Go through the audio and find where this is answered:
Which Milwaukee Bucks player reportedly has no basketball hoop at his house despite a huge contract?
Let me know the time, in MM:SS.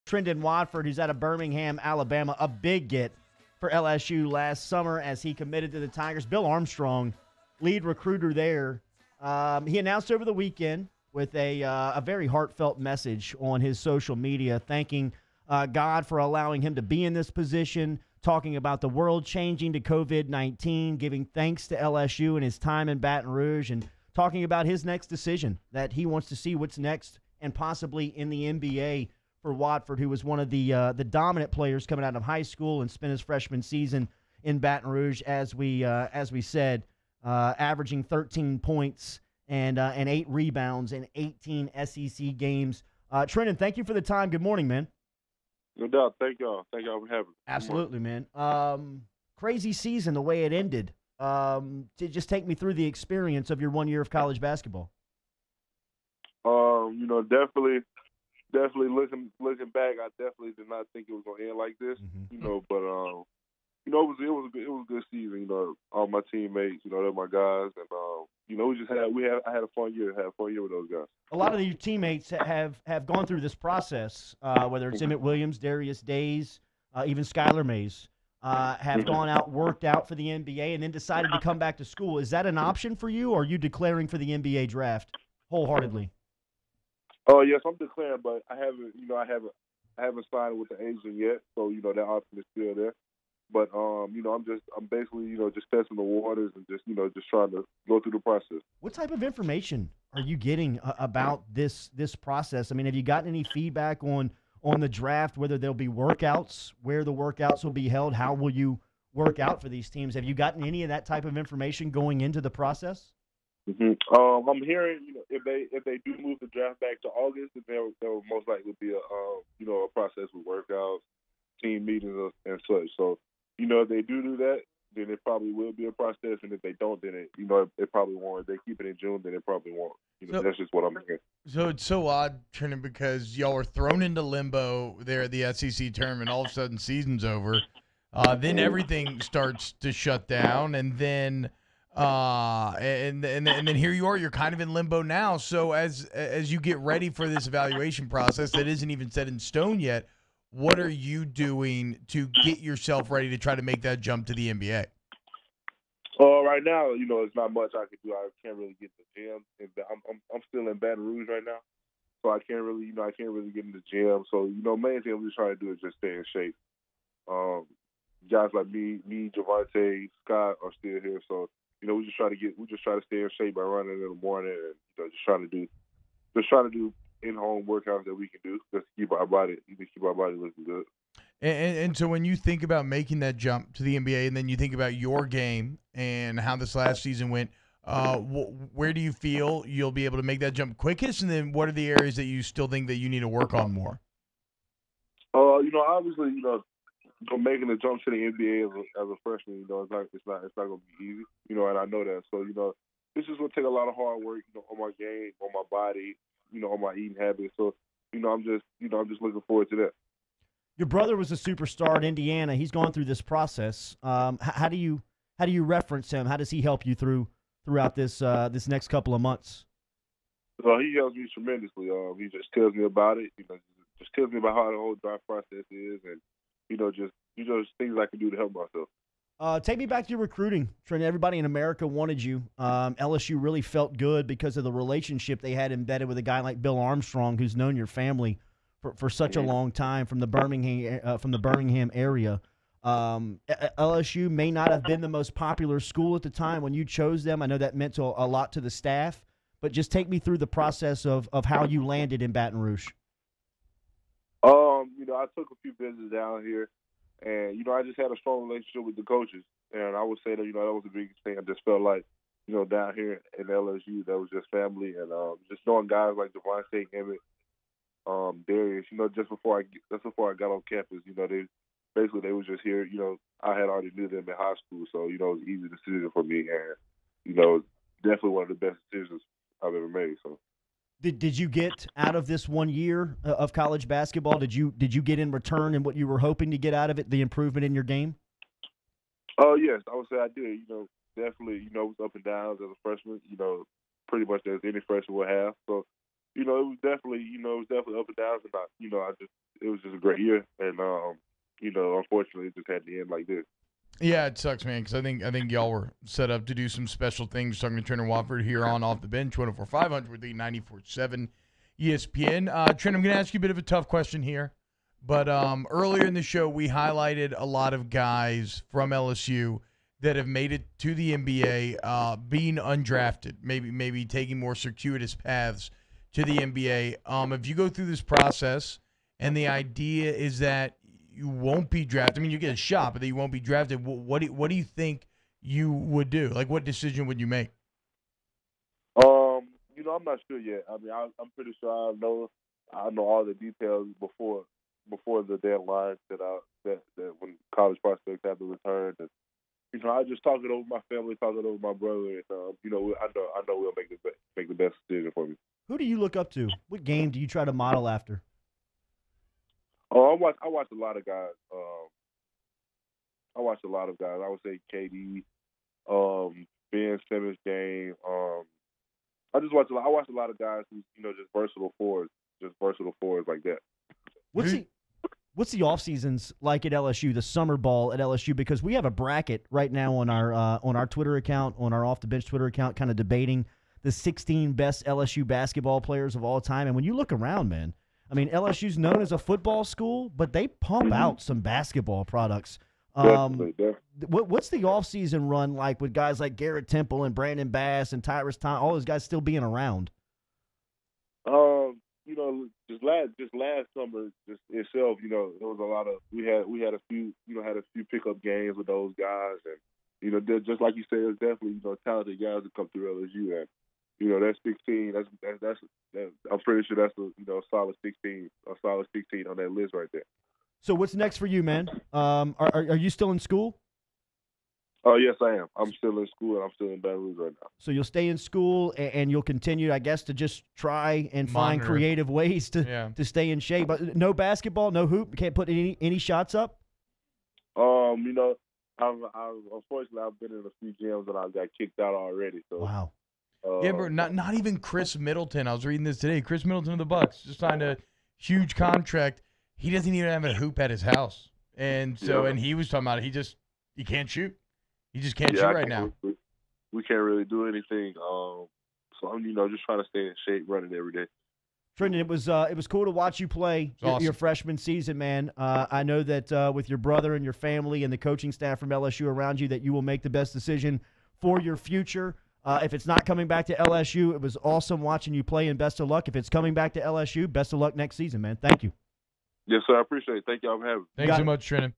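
07:26.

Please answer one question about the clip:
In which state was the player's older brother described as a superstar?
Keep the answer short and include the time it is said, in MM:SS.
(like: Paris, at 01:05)
Indiana, at 03:32.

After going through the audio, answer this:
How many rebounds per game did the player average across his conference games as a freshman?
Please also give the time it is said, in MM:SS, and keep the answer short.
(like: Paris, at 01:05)
8, at 00:40.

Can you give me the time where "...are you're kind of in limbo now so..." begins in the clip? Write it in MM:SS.
02:24.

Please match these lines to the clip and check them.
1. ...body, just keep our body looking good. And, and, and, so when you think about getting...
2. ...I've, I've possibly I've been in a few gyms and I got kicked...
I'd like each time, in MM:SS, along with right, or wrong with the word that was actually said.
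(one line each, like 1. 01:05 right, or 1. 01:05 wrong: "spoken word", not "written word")
1. 02:59 wrong: "making", not "getting"
2. 07:18 wrong: "unfortunately", not "possibly".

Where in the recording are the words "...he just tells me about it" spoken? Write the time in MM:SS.
03:42.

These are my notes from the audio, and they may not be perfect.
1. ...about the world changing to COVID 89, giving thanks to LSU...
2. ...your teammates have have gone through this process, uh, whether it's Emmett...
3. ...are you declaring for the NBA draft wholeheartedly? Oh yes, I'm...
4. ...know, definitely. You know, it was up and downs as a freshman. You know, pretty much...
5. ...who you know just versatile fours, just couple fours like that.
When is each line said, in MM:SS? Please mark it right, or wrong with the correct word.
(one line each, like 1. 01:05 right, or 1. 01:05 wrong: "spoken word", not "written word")
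1. 00:18 wrong: "19", not "89"
2. 01:11 right
3. 01:23 right
4. 04:50 right
5. 06:10 wrong: "versatile", not "couple".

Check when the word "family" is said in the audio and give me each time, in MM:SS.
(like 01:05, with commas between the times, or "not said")
03:57, 04:24, 05:50, 07:47.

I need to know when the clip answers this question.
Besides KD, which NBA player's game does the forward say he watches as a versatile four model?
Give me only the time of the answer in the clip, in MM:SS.
06:06.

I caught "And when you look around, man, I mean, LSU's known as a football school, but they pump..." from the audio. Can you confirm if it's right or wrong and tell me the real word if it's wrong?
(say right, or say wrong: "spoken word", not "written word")
right.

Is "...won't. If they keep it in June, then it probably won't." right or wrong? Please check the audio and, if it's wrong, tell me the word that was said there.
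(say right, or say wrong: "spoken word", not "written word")
right.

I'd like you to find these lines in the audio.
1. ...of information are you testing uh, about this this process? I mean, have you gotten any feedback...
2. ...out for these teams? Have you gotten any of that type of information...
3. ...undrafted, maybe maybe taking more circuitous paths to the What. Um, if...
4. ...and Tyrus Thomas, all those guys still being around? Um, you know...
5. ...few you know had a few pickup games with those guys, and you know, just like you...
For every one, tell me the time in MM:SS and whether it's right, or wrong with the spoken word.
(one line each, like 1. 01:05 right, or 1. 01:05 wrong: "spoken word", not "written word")
1. 01:39 wrong: "getting", not "testing"
2. 01:49 right
3. 05:22 wrong: "NBA", not "What"
4. 06:37 right
5. 06:46 right.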